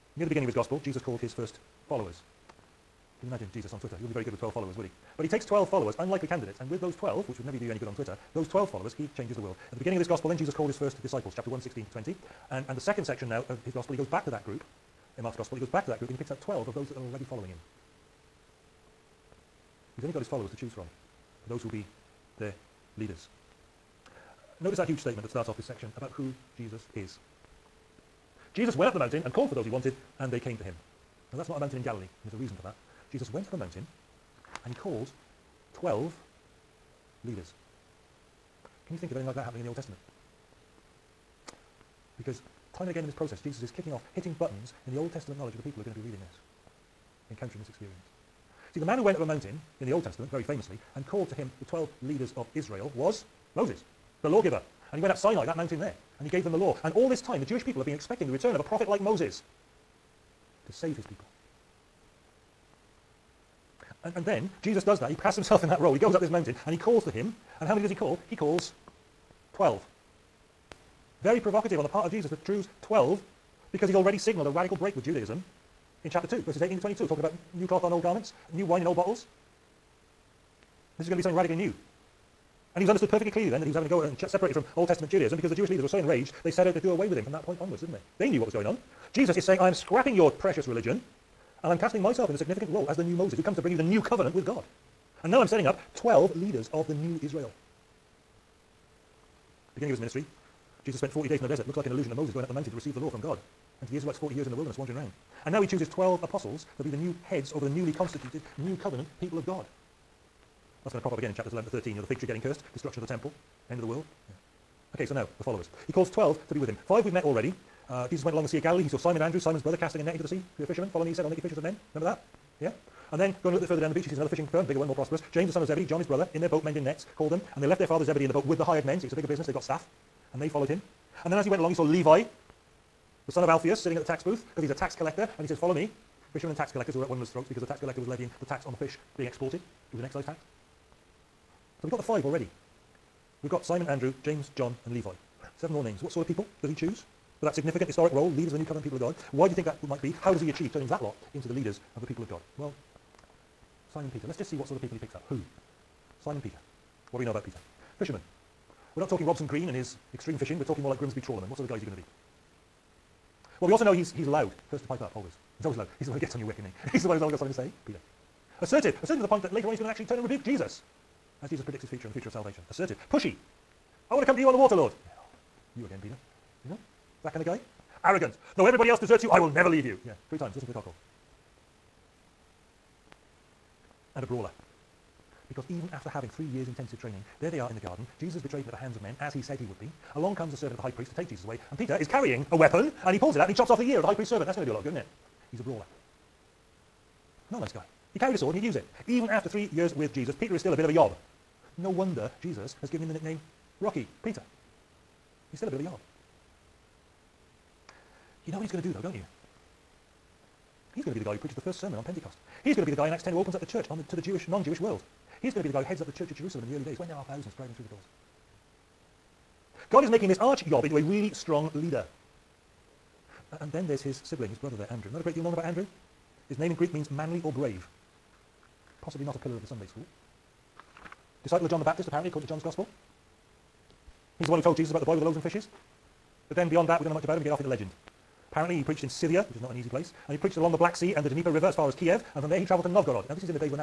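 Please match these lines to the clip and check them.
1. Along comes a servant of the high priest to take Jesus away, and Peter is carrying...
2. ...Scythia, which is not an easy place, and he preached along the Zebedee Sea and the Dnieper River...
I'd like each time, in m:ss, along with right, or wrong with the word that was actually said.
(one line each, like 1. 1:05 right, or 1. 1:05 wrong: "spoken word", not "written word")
1. 3:10 right
2. 3:59 wrong: "Black", not "Zebedee".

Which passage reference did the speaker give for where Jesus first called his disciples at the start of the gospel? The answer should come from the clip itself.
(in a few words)
Chapter 1, 16 to 20.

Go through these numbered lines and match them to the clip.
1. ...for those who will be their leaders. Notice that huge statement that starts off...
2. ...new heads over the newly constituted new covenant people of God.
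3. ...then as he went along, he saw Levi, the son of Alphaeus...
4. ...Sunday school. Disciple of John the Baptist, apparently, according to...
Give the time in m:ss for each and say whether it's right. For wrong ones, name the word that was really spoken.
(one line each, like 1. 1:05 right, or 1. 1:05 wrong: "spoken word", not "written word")
1. 0:21 right
2. 1:46 right
3. 2:11 right
4. 3:49 right.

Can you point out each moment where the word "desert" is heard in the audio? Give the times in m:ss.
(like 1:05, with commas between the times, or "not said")
1:41, 2:58.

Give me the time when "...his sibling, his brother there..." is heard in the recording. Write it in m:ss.
3:44.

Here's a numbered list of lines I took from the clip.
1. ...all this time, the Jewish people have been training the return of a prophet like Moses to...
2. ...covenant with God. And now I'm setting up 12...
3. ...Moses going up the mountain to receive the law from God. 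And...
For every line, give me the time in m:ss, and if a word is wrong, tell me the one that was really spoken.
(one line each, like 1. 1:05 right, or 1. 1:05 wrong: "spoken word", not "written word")
1. 0:56 wrong: "expecting", not "training"
2. 1:34 right
3. 1:42 right.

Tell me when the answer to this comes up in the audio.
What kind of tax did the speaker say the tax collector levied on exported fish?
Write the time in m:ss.
2:20.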